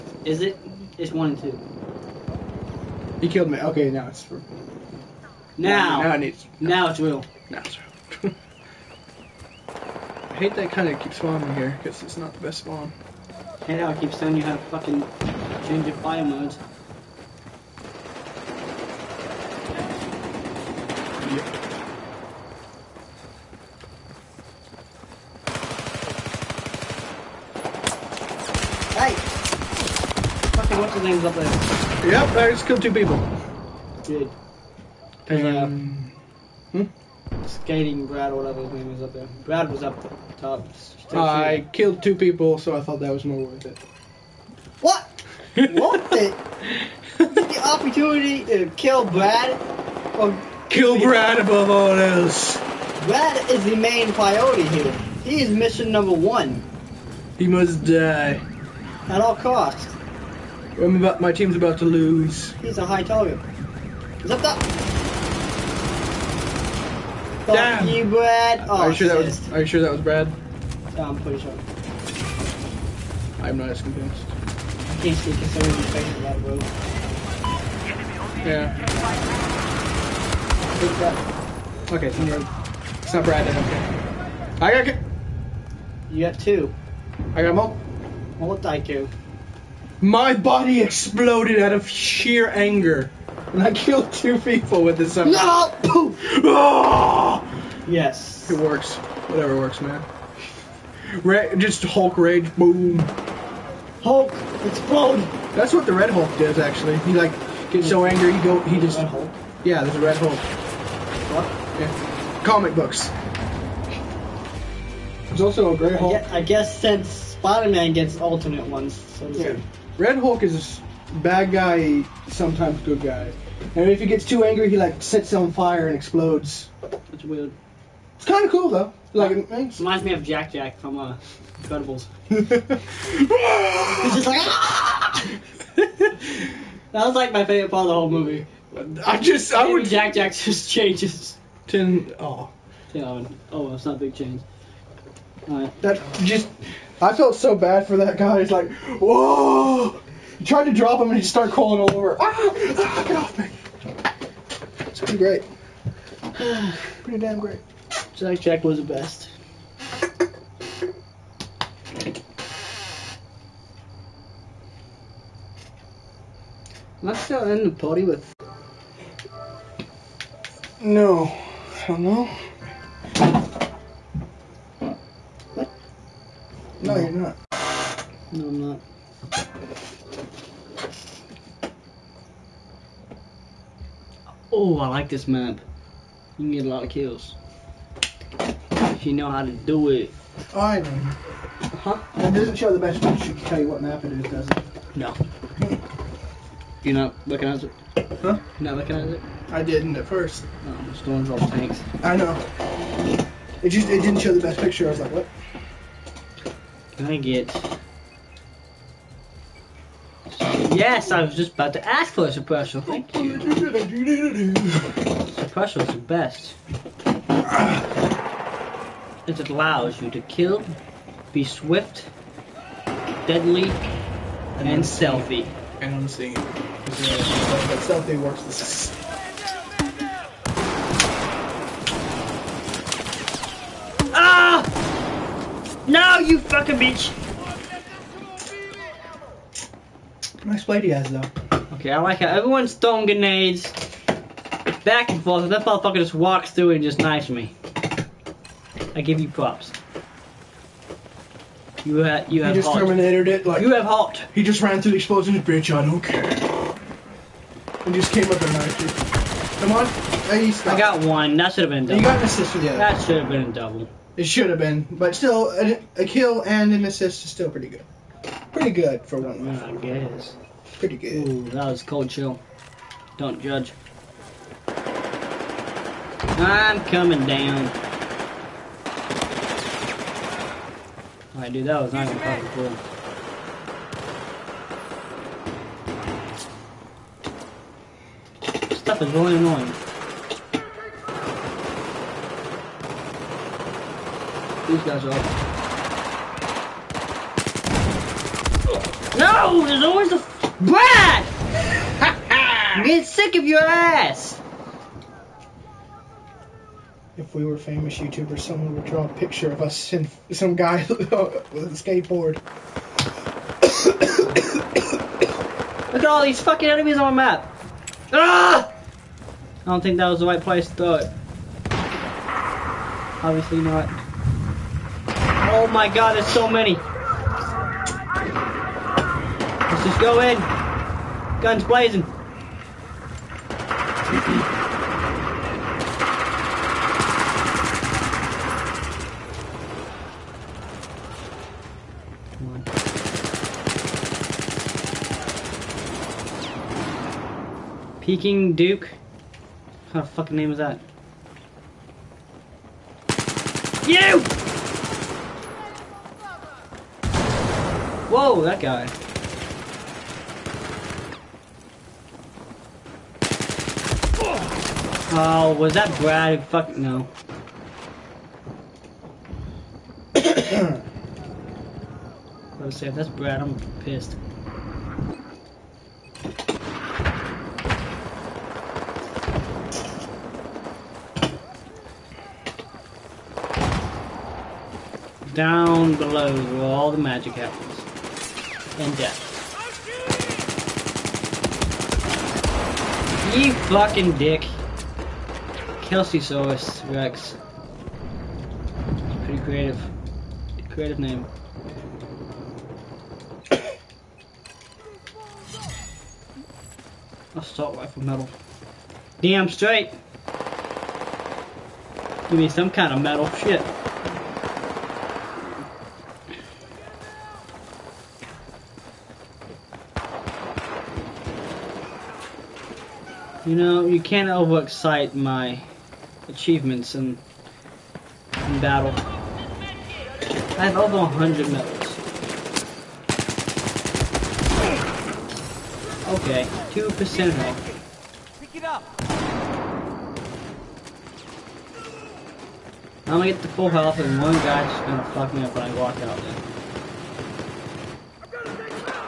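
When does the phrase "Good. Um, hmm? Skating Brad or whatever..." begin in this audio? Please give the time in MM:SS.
00:34.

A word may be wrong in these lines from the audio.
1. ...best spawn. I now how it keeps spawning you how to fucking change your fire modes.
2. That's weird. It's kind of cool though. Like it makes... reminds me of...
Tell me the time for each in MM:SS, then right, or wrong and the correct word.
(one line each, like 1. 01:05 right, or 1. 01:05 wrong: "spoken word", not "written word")
1. 00:12 wrong: "telling", not "spawning"
2. 02:07 right.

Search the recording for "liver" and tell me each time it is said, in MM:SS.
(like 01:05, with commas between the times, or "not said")
not said.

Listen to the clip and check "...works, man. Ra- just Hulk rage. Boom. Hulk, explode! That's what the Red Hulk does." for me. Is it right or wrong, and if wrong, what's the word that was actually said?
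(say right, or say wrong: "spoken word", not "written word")
right.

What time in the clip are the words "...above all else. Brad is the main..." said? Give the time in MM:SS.
00:51.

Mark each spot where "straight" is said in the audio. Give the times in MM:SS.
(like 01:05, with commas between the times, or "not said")
06:49.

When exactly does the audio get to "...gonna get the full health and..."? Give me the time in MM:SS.
07:23.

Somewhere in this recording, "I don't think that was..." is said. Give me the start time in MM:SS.
05:19.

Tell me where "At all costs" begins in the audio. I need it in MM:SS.
00:59.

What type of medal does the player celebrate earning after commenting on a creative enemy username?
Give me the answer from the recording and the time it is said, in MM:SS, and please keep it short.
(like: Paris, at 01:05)
Assault rifle medal, at 06:47.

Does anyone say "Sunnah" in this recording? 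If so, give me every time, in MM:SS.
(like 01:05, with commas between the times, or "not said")
not said.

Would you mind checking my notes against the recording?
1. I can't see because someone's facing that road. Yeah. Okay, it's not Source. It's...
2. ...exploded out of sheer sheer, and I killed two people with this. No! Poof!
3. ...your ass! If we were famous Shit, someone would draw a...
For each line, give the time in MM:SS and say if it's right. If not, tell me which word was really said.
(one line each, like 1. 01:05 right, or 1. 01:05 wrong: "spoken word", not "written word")
1. 01:14 wrong: "Brad", not "Source"
2. 01:30 wrong: "anger", not "sheer"
3. 05:03 wrong: "YouTubers", not "Shit".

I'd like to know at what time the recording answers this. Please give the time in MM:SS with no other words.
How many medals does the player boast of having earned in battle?
07:10.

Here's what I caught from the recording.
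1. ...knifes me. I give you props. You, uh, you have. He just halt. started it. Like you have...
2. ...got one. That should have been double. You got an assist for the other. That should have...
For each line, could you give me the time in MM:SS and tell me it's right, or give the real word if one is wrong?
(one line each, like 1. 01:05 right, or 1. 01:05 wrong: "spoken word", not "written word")
1. 04:06 wrong: "terminated", not "started"
2. 04:20 right.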